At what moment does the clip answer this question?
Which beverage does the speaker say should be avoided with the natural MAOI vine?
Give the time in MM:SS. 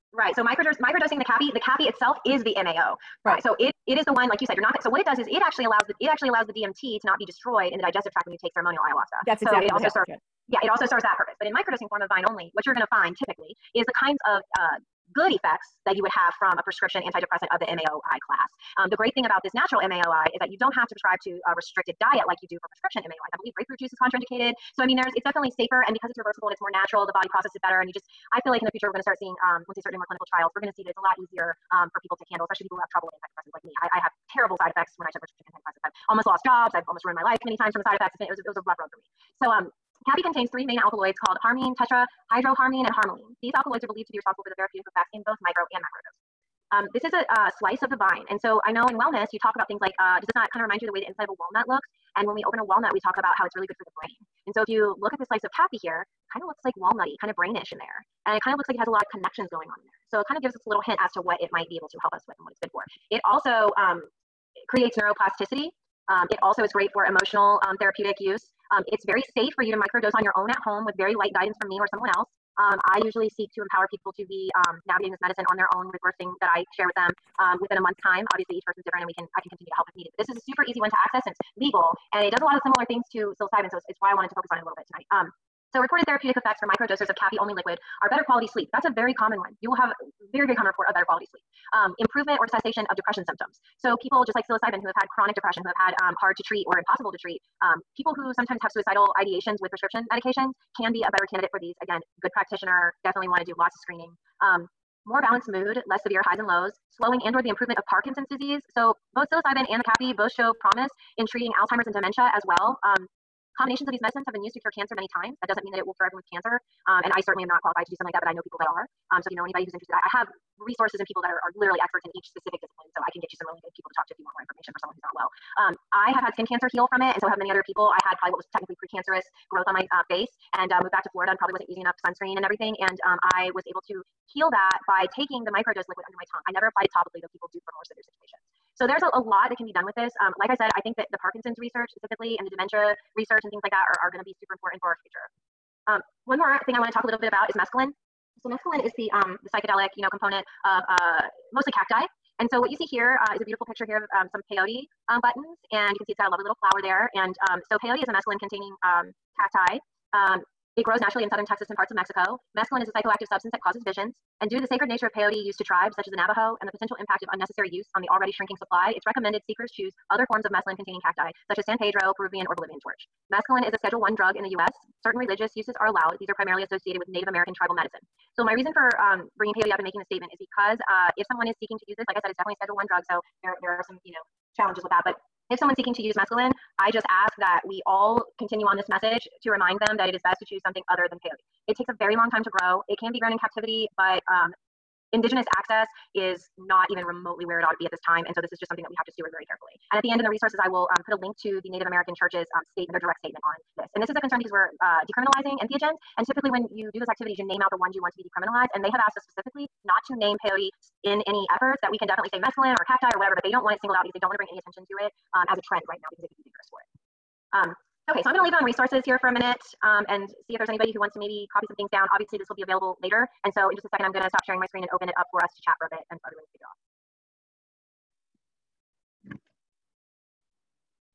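00:23.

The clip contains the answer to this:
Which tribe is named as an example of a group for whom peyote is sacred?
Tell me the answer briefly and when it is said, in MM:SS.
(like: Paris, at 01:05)
Navajo, at 02:46.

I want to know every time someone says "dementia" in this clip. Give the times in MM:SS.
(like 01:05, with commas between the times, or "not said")
01:51, 02:22.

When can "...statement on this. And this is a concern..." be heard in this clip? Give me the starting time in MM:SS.
03:23.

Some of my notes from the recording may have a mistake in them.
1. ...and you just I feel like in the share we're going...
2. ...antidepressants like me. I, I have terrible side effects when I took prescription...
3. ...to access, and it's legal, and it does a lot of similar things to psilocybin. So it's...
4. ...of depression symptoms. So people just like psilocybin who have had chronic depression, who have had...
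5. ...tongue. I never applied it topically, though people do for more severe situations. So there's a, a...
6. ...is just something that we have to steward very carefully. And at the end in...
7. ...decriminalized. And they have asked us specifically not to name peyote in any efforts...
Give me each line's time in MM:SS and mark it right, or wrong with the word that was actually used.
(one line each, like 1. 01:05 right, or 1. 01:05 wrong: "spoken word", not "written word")
1. 00:27 wrong: "future", not "share"
2. 00:33 right
3. 01:20 right
4. 01:32 right
5. 02:16 right
6. 03:18 right
7. 03:28 right.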